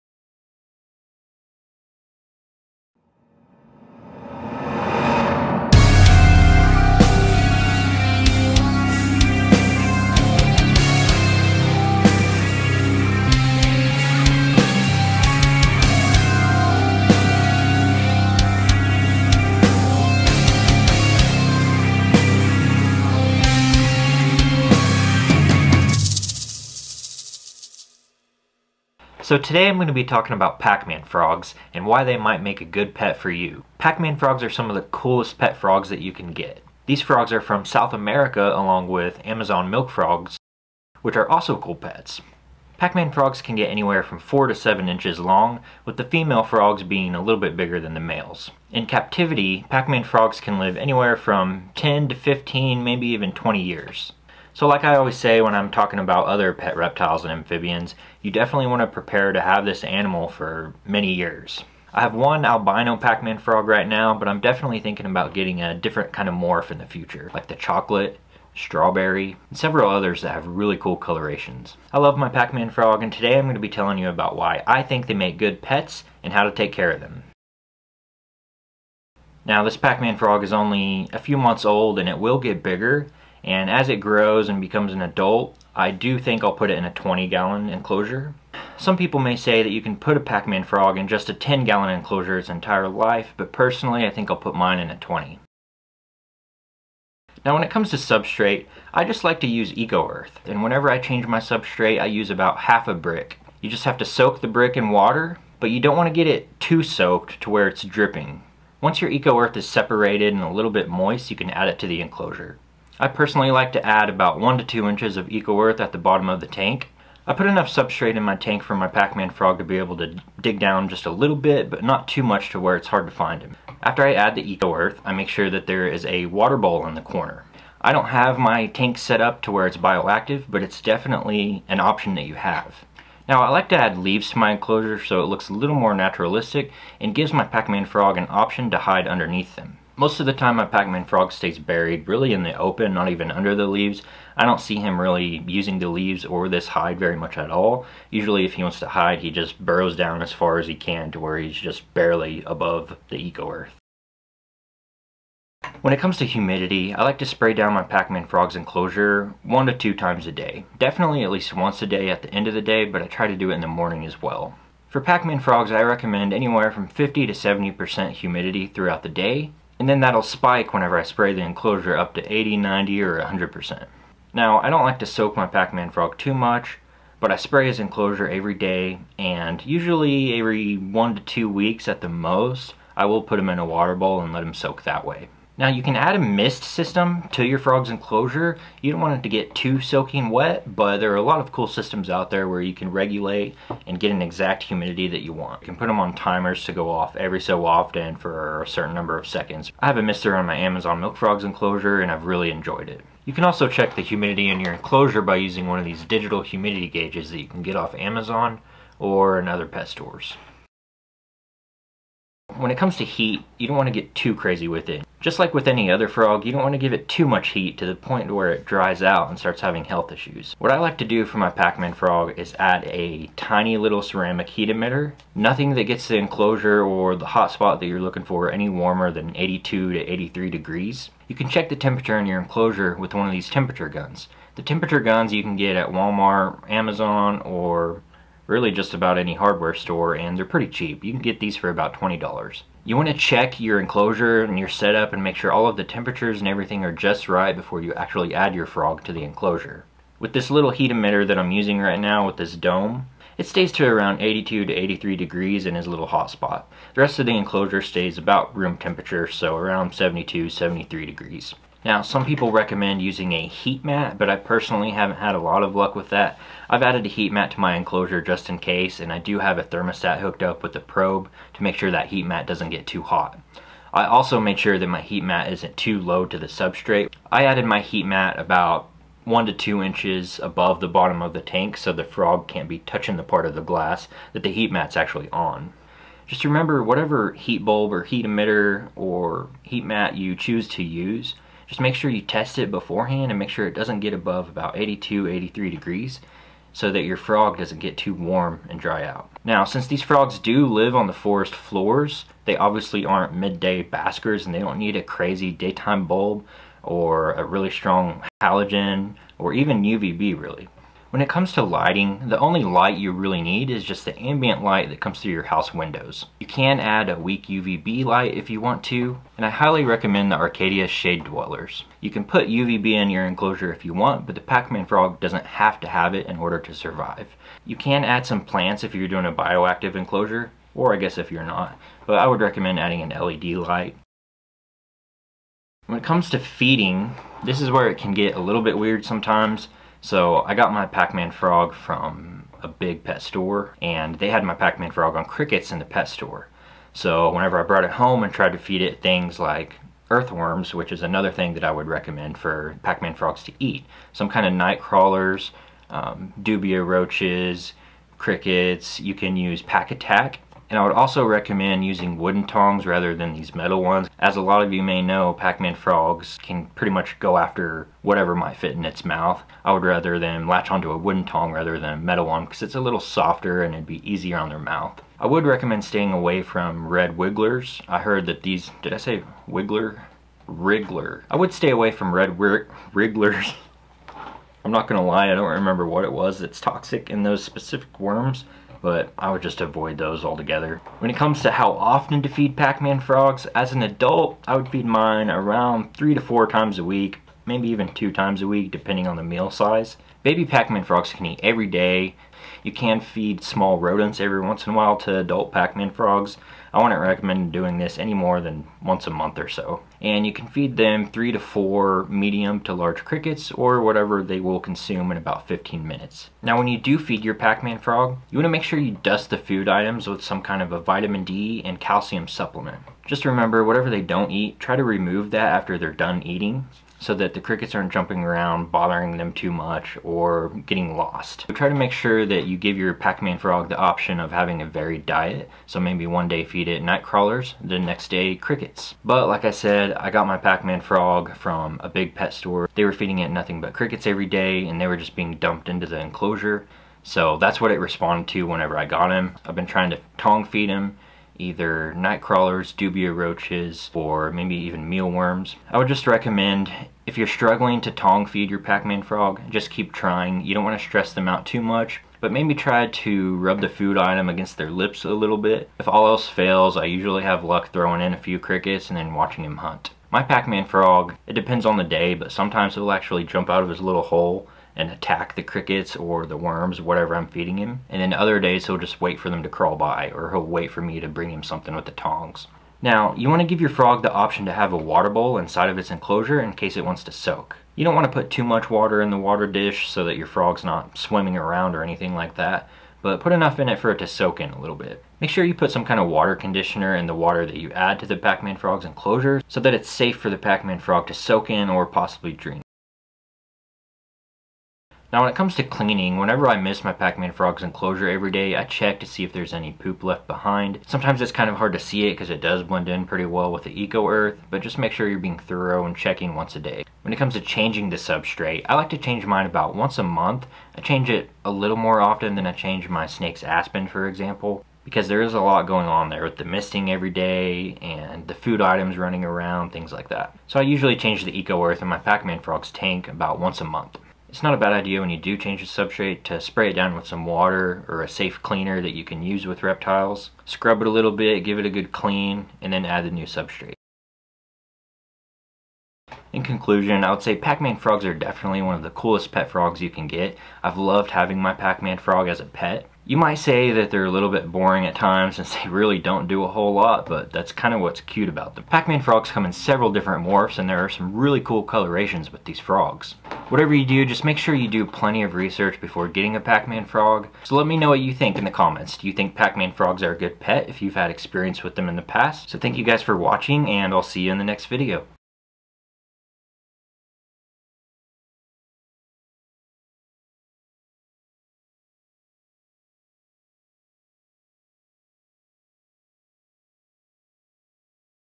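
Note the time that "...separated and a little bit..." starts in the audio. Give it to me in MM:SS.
01:49.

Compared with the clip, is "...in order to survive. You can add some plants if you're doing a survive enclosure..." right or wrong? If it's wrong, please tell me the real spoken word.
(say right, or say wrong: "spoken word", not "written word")
wrong: "bioactive", not "survive".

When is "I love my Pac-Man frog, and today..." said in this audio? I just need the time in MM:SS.
01:11.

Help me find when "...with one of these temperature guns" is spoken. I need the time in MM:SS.
03:52.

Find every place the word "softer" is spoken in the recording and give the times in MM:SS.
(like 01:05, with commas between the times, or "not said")
06:13.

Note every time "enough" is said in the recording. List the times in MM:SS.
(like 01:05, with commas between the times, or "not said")
01:57, 08:13.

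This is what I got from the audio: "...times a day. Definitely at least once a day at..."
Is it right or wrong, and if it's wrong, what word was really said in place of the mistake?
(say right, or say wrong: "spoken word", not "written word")
right.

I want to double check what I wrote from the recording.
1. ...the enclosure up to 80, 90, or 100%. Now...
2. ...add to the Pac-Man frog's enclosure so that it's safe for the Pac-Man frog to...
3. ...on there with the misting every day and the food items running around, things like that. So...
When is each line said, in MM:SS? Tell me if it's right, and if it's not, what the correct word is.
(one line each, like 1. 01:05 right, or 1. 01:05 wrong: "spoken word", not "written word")
1. 02:51 right
2. 08:17 right
3. 08:45 right.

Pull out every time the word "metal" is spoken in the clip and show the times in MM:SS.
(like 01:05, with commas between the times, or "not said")
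06:03, 06:11.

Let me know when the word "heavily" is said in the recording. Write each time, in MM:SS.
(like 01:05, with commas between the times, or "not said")
not said.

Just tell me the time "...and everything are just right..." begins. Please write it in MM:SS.
04:06.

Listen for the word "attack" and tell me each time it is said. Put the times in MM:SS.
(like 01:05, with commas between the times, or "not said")
05:59, 07:54.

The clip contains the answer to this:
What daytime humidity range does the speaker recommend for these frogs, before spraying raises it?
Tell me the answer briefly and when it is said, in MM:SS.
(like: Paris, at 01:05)
50 to 70%, at 02:46.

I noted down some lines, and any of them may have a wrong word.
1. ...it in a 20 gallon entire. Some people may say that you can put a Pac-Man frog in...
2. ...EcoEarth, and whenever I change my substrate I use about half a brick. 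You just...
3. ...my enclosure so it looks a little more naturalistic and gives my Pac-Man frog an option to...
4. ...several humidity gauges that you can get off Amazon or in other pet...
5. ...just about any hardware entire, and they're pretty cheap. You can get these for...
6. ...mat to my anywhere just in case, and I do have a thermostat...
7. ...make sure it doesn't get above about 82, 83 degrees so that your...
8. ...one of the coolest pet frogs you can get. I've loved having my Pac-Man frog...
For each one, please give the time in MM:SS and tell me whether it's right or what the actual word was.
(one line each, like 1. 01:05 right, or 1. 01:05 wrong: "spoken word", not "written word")
1. 01:26 wrong: "enclosure", not "entire"
2. 01:39 right
3. 02:14 right
4. 03:26 wrong: "digital", not "several"
5. 03:58 wrong: "store", not "entire"
6. 04:27 wrong: "enclosure", not "anywhere"
7. 04:53 right
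8. 09:08 right.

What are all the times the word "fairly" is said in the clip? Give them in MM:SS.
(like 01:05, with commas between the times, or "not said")
not said.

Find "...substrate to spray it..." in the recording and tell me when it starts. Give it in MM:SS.
08:55.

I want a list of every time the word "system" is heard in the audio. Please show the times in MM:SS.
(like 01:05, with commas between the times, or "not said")
03:06, 03:11.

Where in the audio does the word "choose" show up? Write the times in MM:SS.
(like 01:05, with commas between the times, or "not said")
04:50.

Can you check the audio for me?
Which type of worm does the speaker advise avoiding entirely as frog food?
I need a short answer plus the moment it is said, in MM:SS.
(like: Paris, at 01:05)
red wrigglers, at 06:22.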